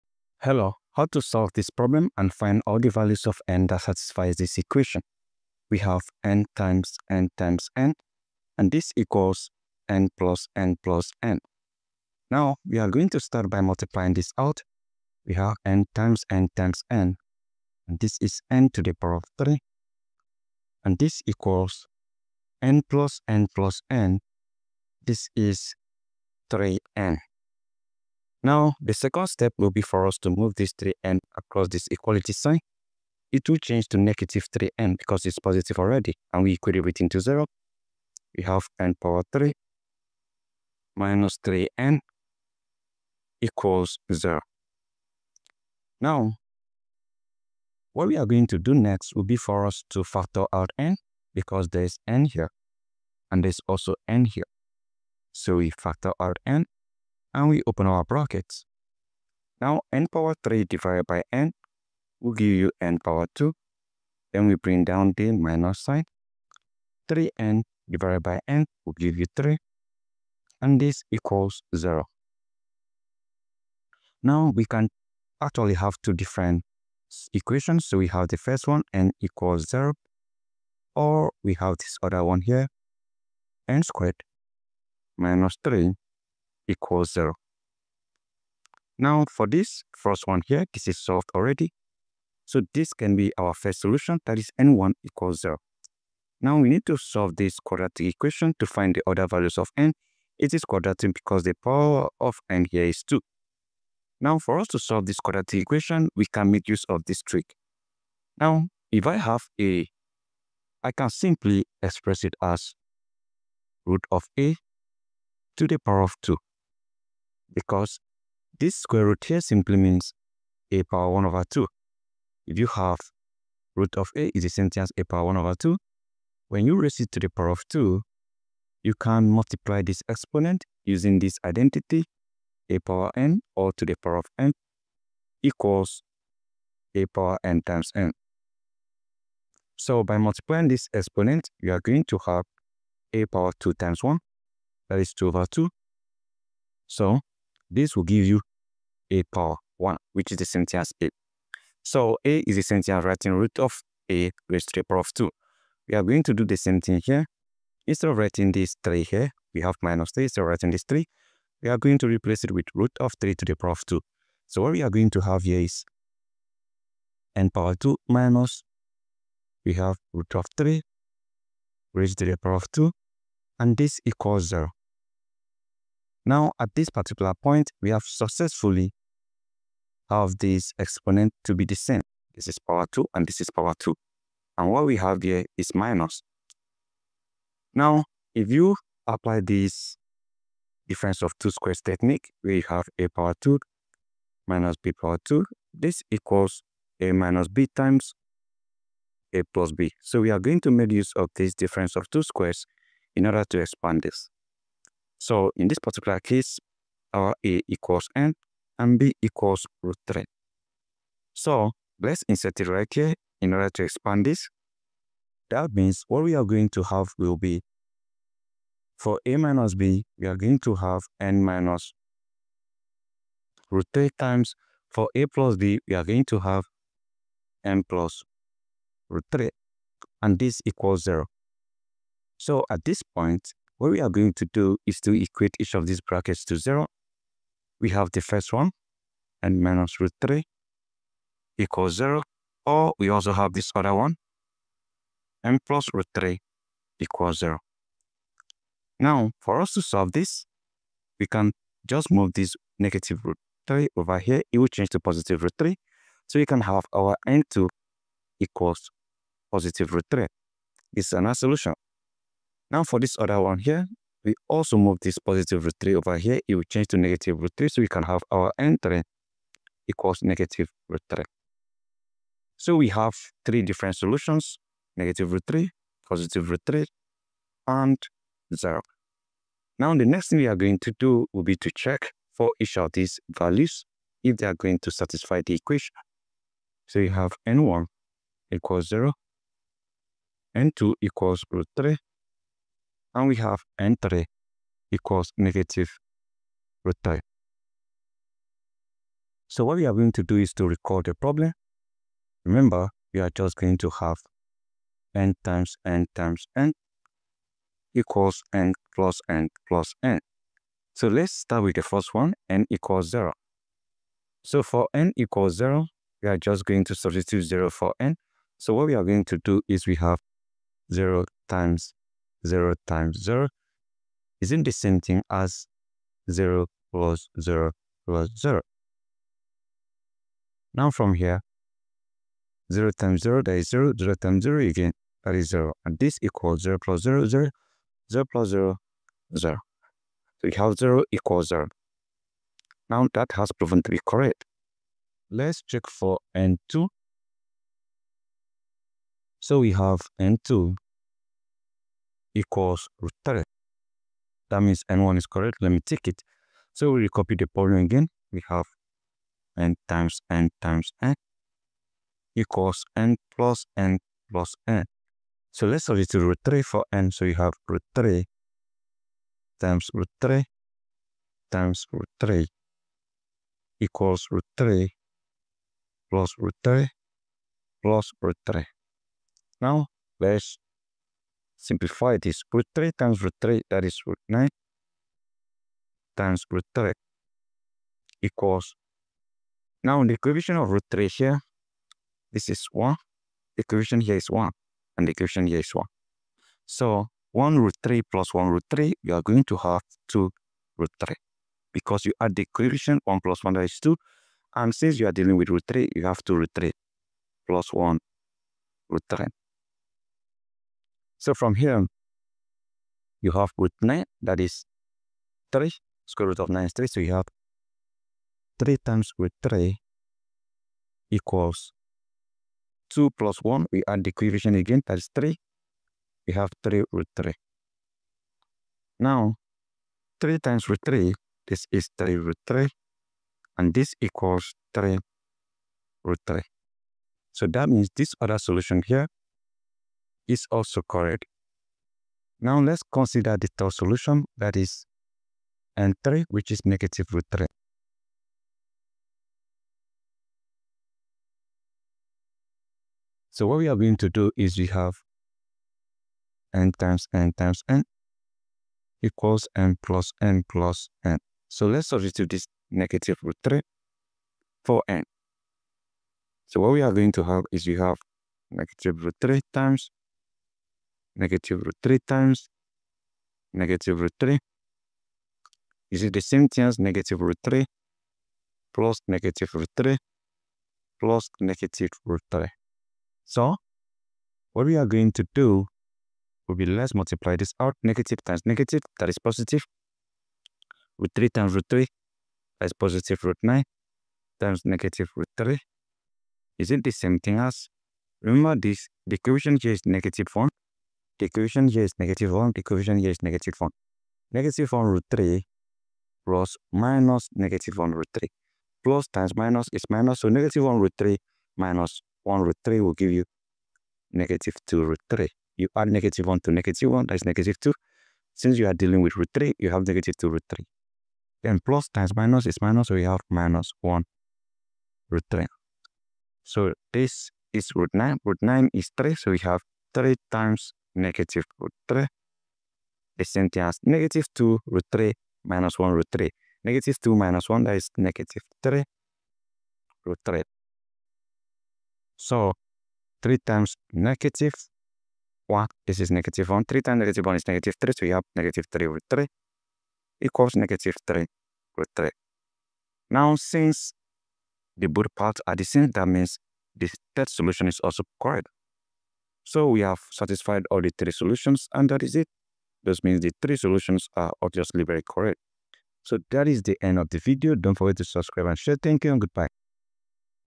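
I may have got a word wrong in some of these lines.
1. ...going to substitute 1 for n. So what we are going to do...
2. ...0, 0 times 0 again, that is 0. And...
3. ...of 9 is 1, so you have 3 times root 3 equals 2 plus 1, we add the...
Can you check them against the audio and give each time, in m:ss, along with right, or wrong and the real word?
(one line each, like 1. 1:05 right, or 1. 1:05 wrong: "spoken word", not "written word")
1. 5:16 wrong: "0", not "1"
2. 5:33 right
3. 6:56 wrong: "3", not "1".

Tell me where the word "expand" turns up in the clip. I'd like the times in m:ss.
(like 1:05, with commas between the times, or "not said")
3:23, 3:33.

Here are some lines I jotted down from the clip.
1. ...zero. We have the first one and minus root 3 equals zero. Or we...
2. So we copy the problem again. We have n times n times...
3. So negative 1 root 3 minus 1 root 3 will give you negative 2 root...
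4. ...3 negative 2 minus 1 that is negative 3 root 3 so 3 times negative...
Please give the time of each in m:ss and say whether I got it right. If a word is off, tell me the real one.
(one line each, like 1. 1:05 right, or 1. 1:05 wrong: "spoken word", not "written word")
1. 3:56 right
2. 5:56 right
3. 8:30 right
4. 8:56 right.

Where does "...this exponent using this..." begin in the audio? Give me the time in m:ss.
2:09.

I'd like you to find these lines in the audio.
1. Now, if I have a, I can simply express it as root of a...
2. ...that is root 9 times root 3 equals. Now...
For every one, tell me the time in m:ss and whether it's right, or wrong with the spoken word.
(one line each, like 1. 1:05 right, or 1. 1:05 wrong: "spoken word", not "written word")
1. 1:48 right
2. 6:23 right.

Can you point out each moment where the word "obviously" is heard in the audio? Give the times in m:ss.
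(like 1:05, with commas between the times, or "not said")
9:24.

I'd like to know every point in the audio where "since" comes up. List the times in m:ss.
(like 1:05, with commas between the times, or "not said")
6:44, 8:38, 9:13.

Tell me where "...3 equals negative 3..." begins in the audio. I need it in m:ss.
9:09.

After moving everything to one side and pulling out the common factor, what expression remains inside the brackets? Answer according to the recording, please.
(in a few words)
n^2 - 3.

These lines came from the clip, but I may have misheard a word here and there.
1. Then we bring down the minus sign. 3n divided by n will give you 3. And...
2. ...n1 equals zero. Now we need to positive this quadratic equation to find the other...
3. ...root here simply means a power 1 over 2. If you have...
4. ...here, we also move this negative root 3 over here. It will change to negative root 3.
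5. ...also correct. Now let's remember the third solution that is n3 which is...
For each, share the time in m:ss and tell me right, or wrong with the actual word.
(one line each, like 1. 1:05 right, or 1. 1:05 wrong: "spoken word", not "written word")
1. 1:04 right
2. 1:34 wrong: "solve", not "positive"
3. 1:59 right
4. 4:23 wrong: "positive", not "negative"
5. 7:20 wrong: "consider", not "remember".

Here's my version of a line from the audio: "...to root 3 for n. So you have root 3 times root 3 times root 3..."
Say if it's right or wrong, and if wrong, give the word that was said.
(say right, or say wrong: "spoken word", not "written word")
right.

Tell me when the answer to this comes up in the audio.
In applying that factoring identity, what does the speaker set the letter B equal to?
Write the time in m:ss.
3:28.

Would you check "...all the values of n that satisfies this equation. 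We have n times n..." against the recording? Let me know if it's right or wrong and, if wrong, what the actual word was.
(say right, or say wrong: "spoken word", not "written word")
right.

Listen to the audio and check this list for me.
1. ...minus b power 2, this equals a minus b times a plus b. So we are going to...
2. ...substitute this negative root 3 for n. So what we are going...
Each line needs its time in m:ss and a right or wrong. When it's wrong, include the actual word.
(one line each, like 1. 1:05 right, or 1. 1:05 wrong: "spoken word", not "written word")
1. 3:14 right
2. 7:41 right.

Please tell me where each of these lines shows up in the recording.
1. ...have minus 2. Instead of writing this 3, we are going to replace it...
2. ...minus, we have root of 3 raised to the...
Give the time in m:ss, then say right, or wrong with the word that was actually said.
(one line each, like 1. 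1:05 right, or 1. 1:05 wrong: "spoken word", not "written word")
1. 2:39 wrong: "3", not "2"
2. 2:48 right.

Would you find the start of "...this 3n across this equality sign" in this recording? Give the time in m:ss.
0:30.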